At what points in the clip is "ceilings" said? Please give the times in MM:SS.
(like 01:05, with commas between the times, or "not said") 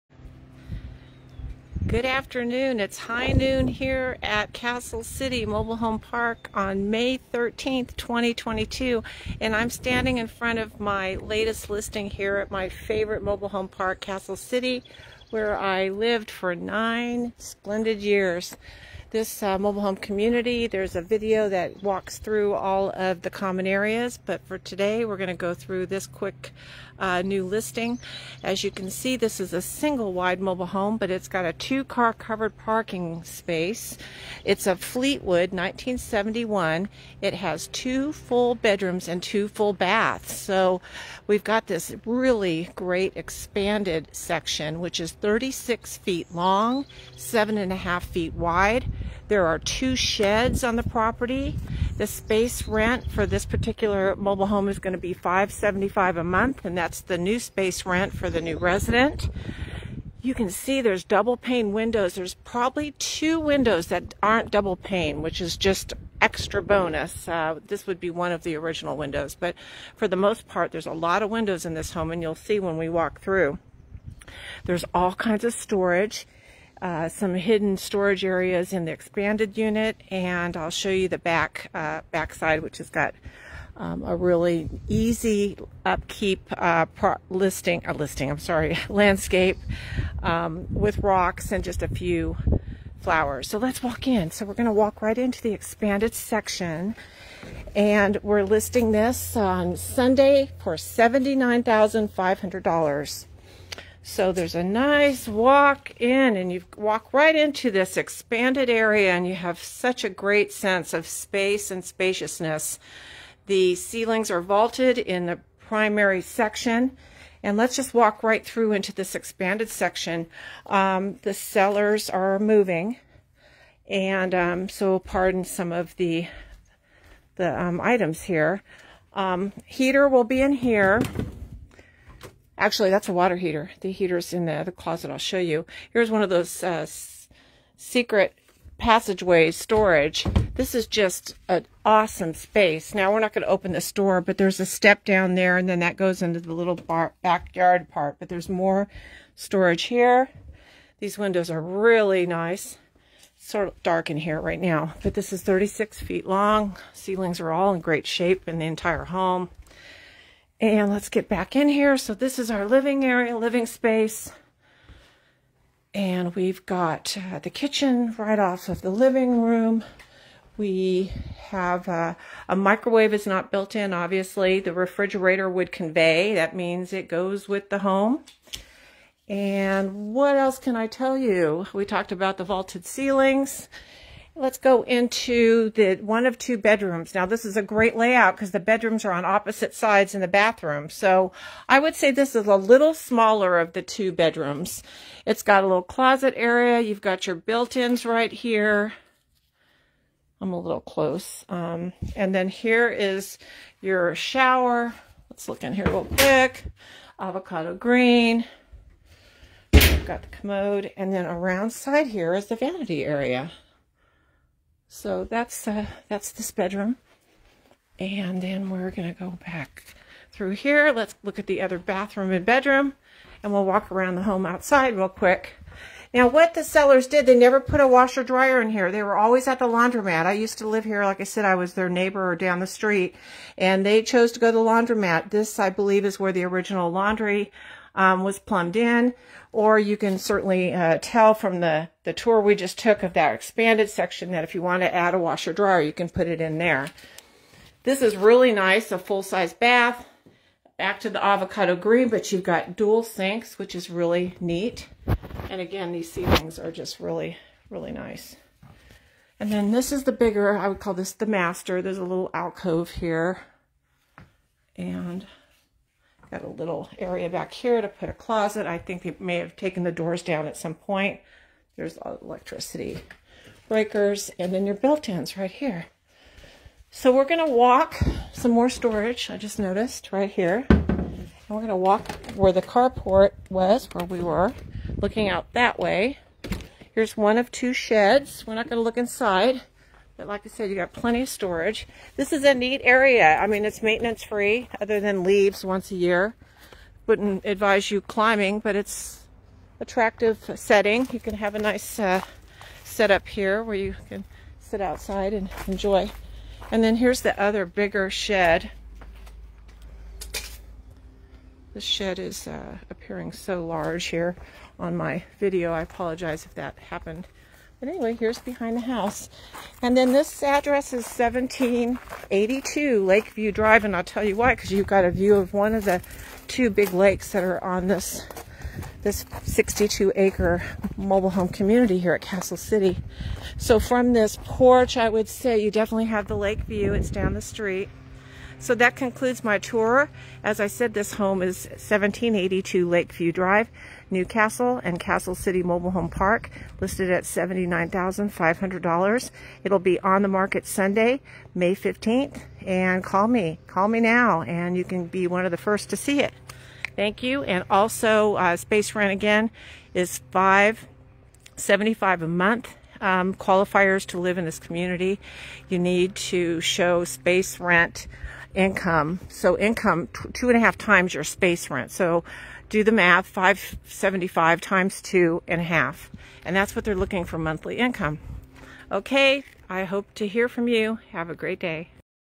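01:53, 02:36, 03:02, 04:16.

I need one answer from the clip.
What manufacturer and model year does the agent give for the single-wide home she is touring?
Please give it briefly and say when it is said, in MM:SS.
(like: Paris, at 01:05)
Fleetwood 1971, at 00:34.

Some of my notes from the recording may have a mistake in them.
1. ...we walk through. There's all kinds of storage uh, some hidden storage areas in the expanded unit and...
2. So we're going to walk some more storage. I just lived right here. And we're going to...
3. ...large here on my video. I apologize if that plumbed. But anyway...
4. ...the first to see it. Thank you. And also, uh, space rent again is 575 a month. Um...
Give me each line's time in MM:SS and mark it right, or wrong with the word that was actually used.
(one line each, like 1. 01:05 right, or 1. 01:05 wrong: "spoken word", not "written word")
1. 01:12 right
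2. 04:36 wrong: "noticed", not "lived"
3. 05:13 wrong: "happened", not "plumbed"
4. 05:55 right.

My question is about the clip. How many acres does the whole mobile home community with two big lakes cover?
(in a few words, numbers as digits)
62 acres.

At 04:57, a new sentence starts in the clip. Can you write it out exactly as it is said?
Wouldn't advise you climbing, but it's attractive setting.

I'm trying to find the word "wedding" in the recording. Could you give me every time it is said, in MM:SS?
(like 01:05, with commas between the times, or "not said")
not said.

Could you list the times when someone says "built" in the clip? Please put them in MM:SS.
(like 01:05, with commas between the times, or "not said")
02:53, 03:17, 04:34.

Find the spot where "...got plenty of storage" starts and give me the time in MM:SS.
04:50.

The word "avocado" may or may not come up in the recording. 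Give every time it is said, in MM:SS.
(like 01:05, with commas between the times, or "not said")
03:27, 04:11.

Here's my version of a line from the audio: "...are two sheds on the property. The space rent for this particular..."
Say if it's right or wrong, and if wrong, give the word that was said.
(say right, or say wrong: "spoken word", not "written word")
right.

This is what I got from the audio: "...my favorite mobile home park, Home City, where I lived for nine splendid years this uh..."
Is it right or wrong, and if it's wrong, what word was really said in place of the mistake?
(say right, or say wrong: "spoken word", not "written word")
wrong: "Castle", not "Home".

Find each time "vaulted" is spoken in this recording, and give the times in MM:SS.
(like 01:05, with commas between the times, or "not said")
01:54, 03:02.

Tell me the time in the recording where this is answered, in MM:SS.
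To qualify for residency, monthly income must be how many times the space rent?
06:10.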